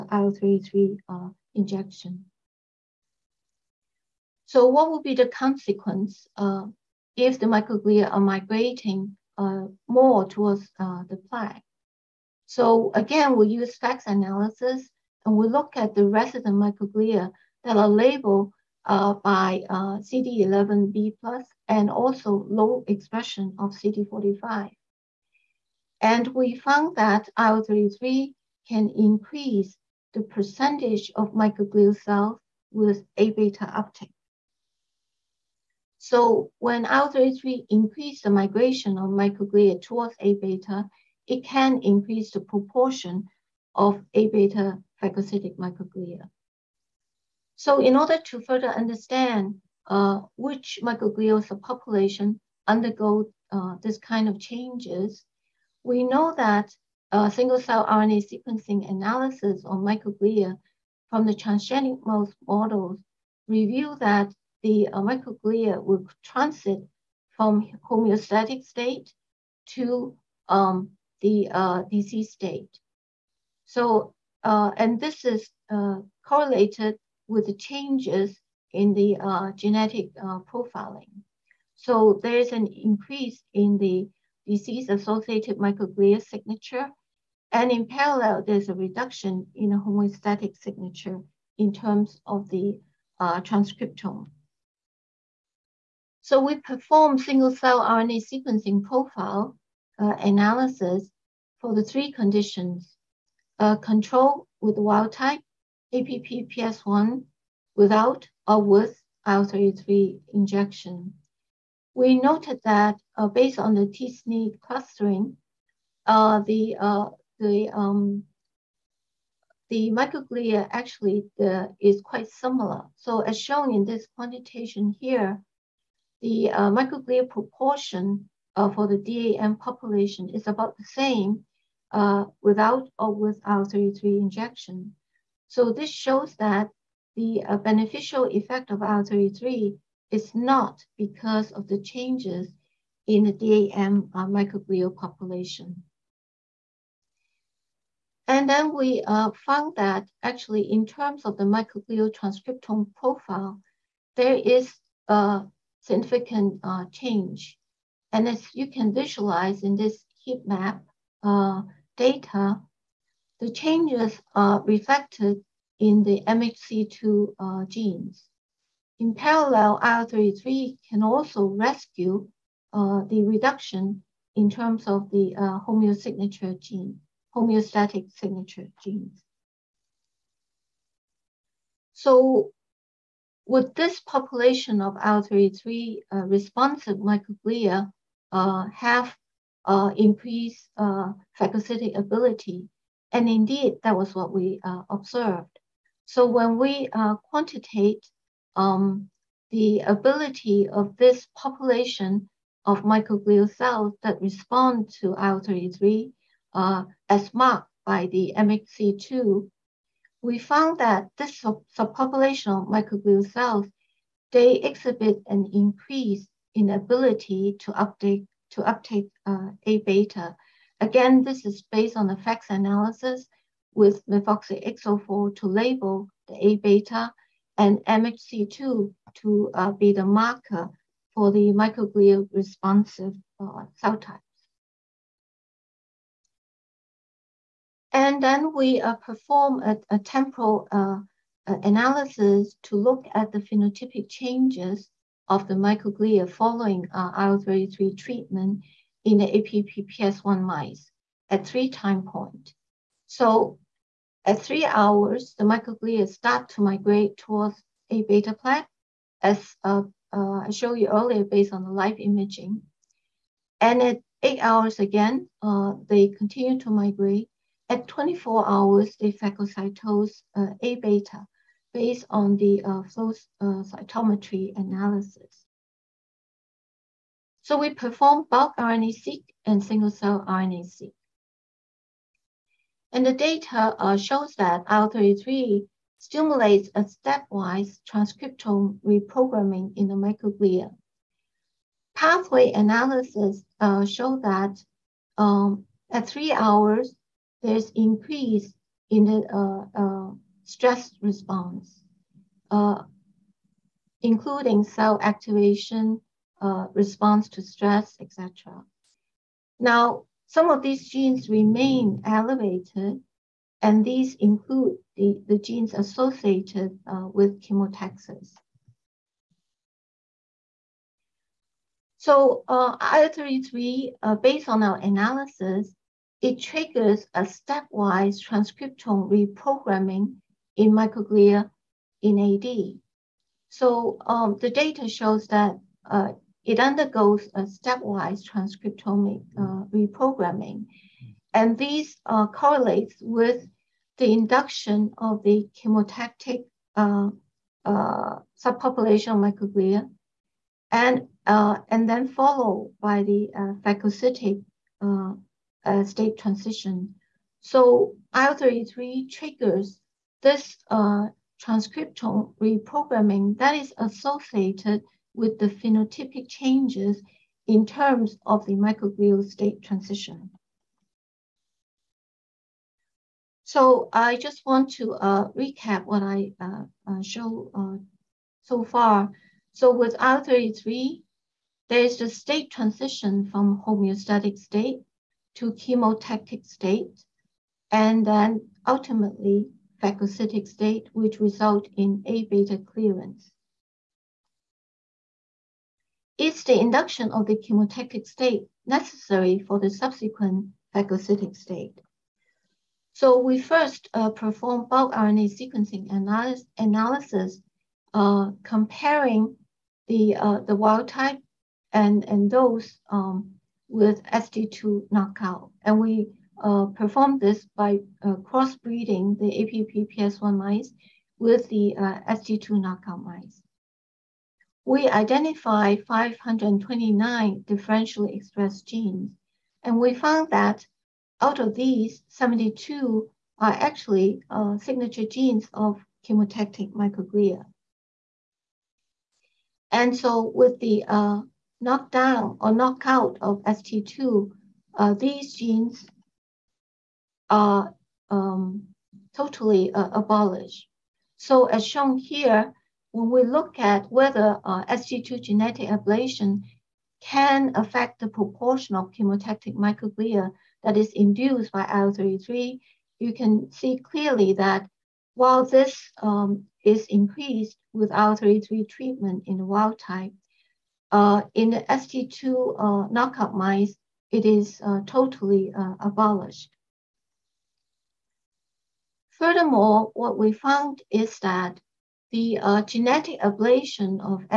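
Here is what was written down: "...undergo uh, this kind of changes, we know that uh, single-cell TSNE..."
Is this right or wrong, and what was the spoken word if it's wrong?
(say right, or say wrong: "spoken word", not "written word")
wrong: "RNA", not "TSNE".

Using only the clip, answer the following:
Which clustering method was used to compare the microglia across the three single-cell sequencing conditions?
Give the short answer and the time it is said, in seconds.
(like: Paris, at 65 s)
T-SNE, at 113 s.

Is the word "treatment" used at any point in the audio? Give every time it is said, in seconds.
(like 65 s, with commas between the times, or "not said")
247 s, 468 s.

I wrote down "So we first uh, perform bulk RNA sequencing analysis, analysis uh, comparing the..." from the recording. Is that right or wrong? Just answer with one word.
right.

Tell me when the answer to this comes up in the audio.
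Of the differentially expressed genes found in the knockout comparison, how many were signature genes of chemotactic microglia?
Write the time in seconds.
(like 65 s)
432 s.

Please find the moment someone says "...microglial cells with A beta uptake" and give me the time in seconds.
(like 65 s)
31 s.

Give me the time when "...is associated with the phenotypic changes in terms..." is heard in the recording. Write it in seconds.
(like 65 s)
363 s.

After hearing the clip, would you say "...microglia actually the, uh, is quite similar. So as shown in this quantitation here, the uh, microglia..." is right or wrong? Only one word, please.
right.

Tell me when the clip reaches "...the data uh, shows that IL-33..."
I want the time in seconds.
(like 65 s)
283 s.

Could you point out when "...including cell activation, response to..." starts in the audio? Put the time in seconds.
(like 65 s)
304 s.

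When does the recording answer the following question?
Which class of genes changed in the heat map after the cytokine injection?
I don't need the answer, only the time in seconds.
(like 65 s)
166 s.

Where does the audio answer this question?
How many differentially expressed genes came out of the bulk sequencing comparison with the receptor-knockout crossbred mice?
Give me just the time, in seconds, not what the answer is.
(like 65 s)
425 s.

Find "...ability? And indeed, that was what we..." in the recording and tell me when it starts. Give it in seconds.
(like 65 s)
191 s.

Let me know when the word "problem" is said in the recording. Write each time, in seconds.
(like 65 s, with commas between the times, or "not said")
not said.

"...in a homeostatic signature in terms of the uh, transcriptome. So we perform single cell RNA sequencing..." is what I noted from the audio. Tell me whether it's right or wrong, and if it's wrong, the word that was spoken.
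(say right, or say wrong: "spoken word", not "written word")
right.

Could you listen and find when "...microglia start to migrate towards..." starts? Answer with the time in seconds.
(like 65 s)
255 s.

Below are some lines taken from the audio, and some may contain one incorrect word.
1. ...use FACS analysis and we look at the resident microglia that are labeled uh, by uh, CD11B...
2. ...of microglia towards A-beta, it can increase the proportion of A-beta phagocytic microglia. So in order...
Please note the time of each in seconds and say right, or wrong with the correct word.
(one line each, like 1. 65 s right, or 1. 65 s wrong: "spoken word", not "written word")
1. 13 s right
2. 38 s right.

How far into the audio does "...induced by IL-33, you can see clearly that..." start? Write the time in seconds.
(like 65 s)
460 s.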